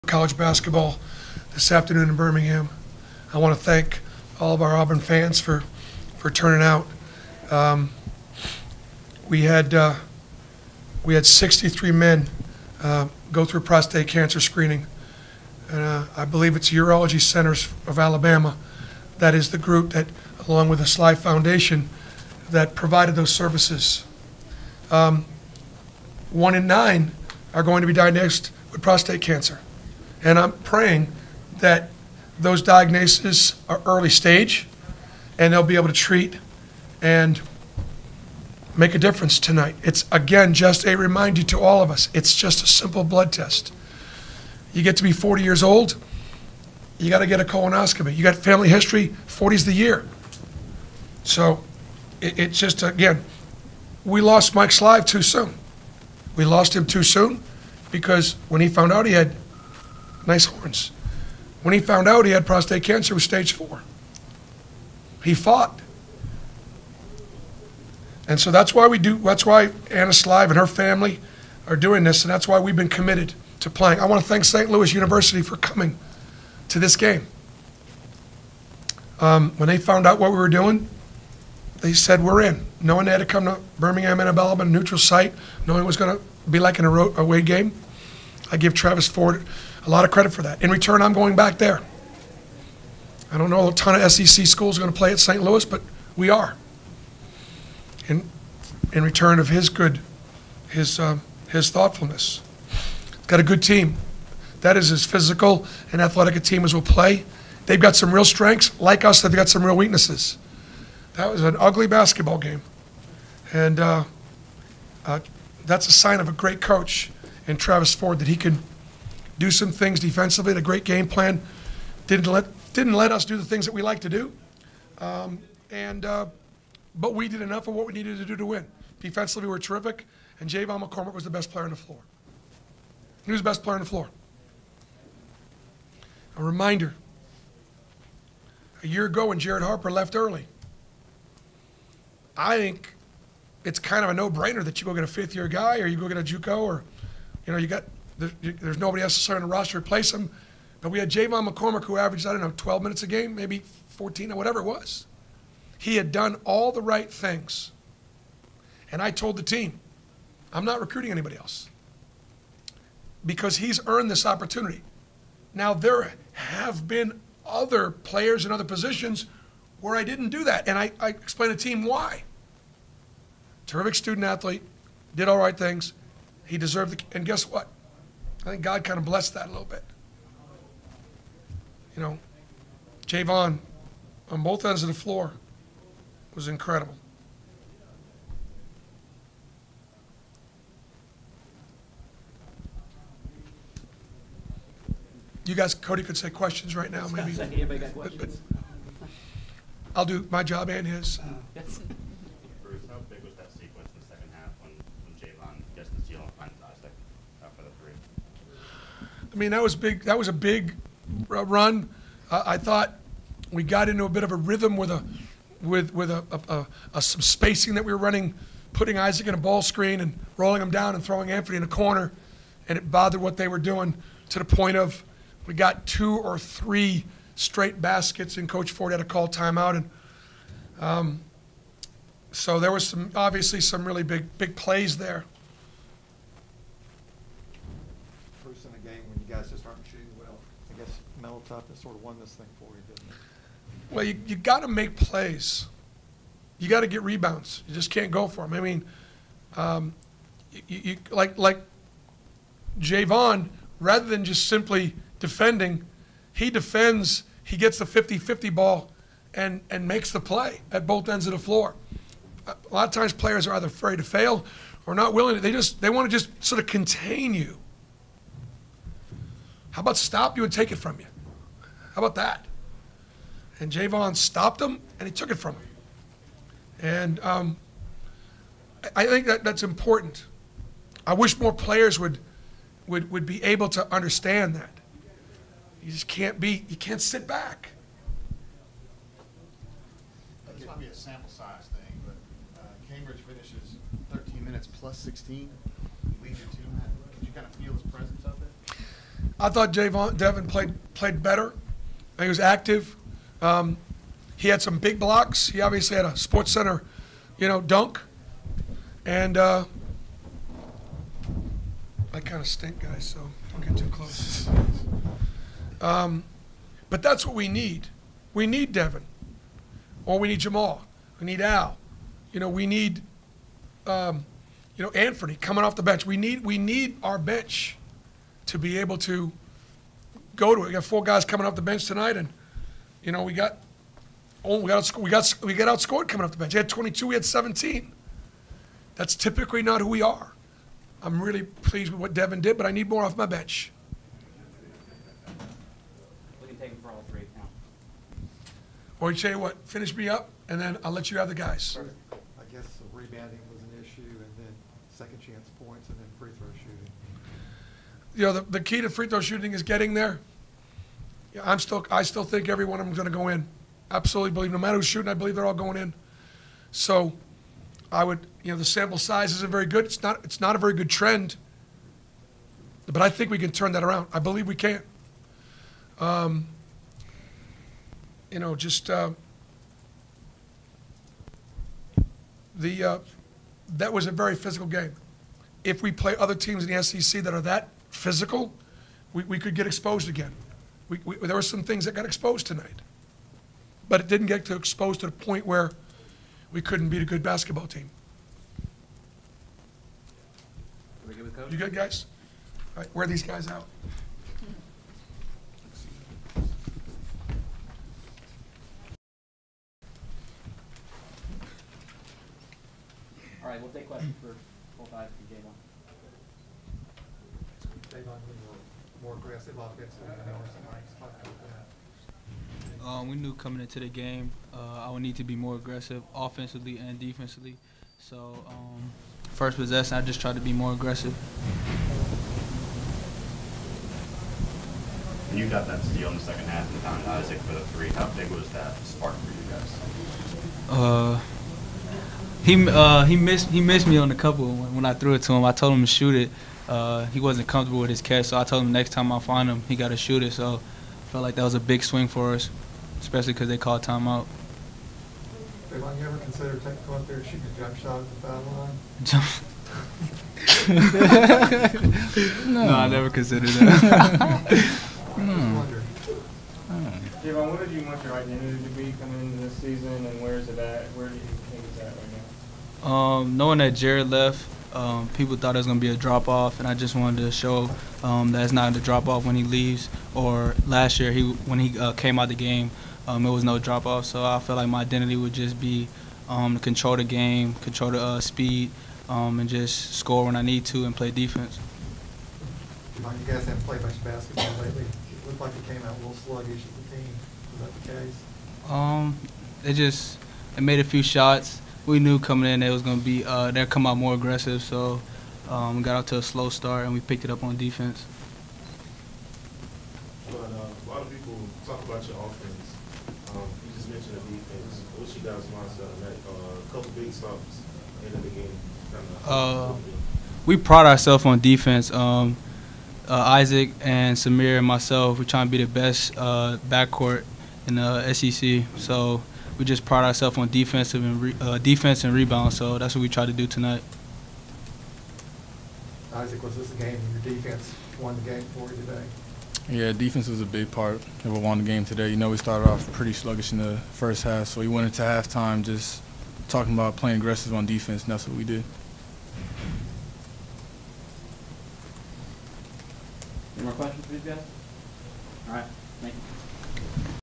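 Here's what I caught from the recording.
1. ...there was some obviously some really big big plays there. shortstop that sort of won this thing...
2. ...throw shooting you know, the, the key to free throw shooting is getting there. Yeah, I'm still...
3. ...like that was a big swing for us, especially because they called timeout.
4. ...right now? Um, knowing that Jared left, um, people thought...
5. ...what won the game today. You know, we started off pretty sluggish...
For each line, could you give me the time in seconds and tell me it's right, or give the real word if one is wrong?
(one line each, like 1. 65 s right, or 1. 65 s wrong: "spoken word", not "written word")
1. 232 s right
2. 356 s right
3. 451 s right
4. 471 s right
5. 541 s right.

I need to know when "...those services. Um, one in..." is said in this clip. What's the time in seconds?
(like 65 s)
23 s.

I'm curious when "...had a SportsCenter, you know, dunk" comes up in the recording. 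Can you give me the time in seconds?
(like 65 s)
305 s.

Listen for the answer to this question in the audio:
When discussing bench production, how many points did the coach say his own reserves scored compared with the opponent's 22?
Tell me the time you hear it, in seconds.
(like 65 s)
337 s.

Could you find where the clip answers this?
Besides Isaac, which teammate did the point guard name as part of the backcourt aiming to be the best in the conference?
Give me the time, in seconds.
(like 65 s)
524 s.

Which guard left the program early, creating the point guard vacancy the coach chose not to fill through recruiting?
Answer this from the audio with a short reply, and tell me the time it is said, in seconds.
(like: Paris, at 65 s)
Jared Harper, at 139 s.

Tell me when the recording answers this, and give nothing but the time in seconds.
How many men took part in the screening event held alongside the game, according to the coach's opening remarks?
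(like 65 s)
11 s.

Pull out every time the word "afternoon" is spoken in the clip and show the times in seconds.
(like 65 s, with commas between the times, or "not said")
1 s.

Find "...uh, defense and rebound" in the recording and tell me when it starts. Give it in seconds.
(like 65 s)
531 s.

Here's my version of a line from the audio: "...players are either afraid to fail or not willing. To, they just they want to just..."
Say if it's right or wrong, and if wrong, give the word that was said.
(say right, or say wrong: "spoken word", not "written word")
right.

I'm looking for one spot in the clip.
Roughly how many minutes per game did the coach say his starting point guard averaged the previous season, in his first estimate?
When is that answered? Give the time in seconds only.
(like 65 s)
152 s.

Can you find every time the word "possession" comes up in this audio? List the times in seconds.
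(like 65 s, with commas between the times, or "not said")
429 s.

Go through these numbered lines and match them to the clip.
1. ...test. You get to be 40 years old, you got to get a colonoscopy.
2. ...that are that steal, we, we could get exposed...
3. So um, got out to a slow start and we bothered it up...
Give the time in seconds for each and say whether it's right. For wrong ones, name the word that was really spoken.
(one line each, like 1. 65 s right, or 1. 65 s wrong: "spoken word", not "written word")
1. 43 s right
2. 387 s wrong: "physical", not "steal"
3. 504 s wrong: "picked", not "bothered".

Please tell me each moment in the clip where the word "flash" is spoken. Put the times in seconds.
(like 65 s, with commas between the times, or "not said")
not said.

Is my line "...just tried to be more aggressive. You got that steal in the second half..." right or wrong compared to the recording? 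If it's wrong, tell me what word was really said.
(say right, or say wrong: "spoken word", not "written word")
right.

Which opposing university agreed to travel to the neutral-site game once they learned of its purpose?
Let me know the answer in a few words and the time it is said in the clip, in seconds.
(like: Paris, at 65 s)
St. Louis University, at 74 s.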